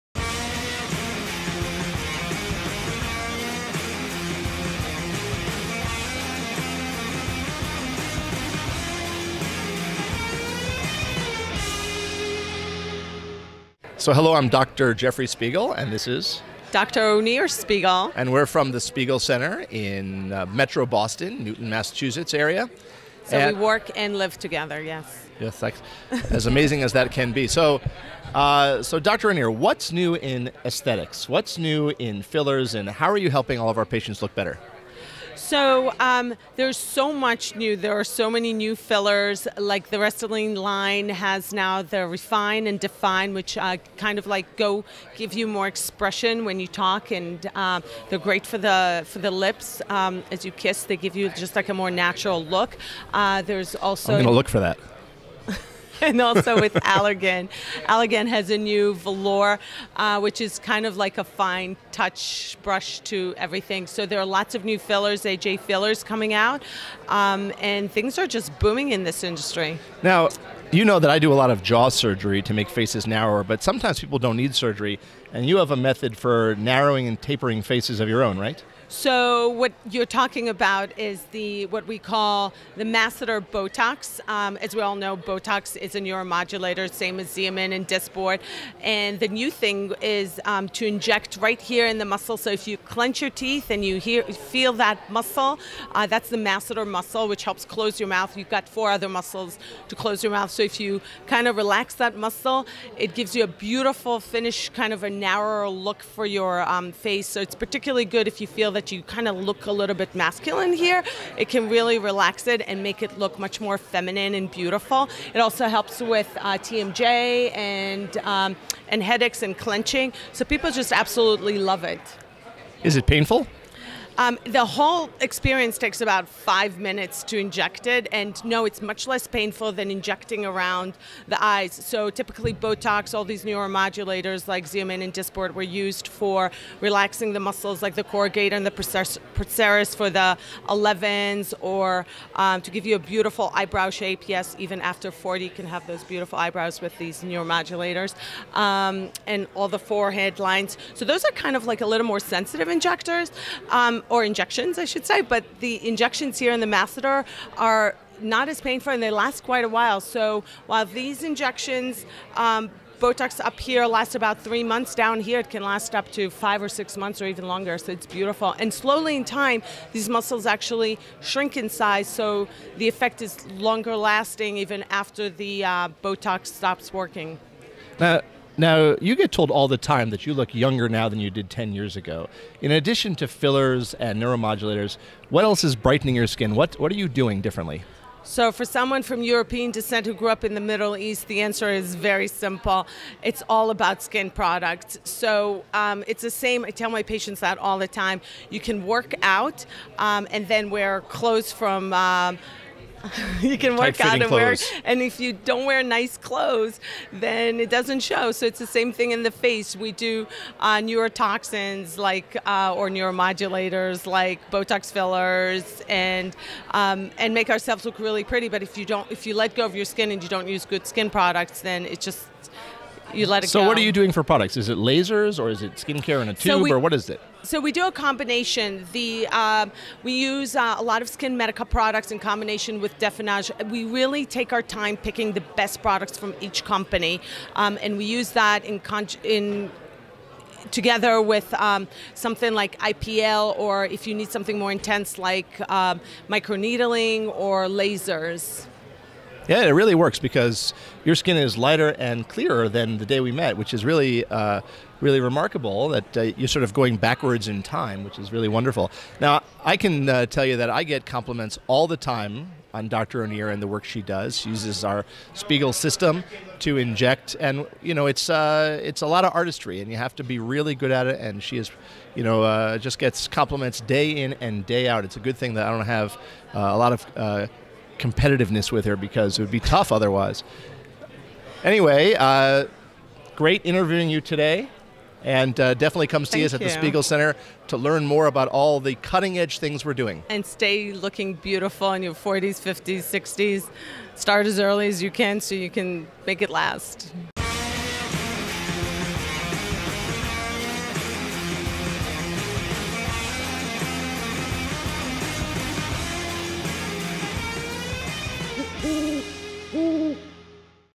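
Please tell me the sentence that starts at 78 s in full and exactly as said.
So what you're talking about is the what we call the masseter Botox.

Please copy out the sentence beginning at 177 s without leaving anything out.
Now, now, you get told all the time that you look younger now than you did 10 years ago.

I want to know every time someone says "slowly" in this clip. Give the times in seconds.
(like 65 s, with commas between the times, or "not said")
168 s.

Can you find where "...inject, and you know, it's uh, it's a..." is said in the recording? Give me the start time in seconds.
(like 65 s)
266 s.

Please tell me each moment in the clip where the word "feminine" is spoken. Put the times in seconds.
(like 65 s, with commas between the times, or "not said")
113 s.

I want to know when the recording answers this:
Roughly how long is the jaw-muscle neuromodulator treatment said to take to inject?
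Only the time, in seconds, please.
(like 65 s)
126 s.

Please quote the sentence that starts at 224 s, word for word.
Is it lasers or is it skincare in a tube so we, or what is it?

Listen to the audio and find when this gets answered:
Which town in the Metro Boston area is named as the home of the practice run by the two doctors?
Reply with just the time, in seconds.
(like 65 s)
21 s.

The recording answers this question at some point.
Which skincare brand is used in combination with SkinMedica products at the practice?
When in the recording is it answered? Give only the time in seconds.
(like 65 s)
232 s.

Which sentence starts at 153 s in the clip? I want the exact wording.
Um, um, or injections, I should say.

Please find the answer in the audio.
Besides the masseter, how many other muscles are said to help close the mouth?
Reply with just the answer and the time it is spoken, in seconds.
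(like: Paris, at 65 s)
4, at 98 s.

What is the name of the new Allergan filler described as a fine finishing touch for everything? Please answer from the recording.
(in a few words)
Velour.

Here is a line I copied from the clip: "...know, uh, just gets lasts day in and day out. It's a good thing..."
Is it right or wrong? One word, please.
wrong.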